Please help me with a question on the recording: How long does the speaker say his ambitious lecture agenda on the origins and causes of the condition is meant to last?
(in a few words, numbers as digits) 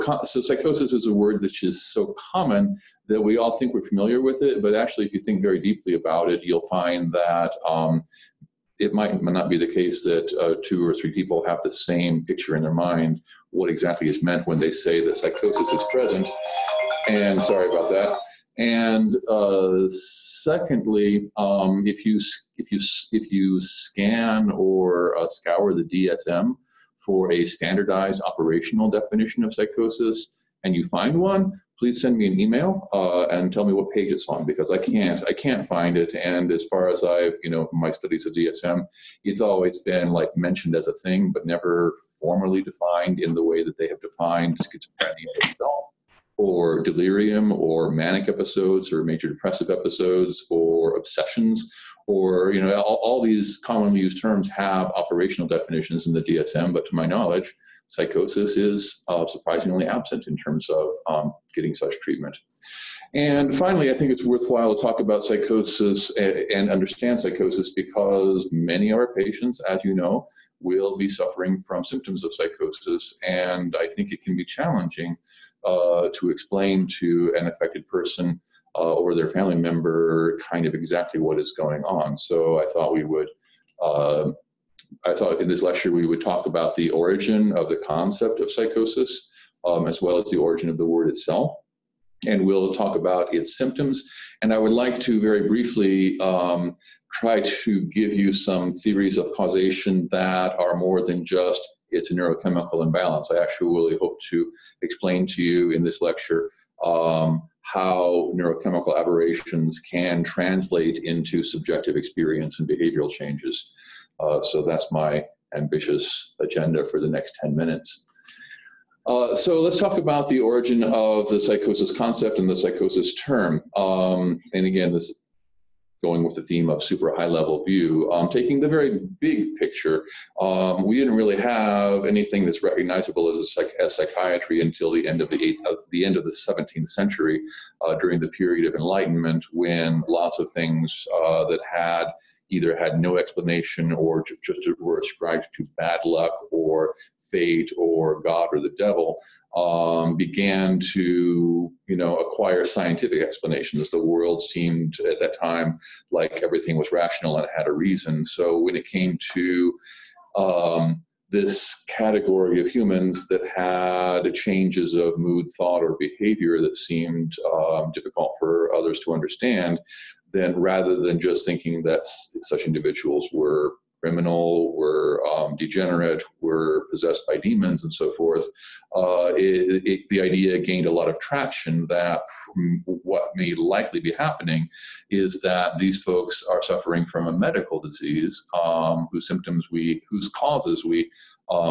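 10 minutes.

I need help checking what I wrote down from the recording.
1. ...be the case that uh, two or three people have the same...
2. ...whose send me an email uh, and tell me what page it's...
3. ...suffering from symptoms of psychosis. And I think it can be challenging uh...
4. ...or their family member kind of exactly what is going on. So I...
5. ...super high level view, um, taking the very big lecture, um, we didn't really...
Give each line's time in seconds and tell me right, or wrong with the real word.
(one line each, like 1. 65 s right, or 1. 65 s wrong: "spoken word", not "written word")
1. 9 s right
2. 31 s wrong: "please", not "whose"
3. 71 s right
4. 78 s right
5. 126 s wrong: "picture", not "lecture".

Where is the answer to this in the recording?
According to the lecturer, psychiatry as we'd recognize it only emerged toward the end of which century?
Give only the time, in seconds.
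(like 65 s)
136 s.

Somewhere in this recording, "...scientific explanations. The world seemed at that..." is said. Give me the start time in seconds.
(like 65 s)
152 s.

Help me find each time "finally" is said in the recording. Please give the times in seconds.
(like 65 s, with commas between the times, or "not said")
63 s.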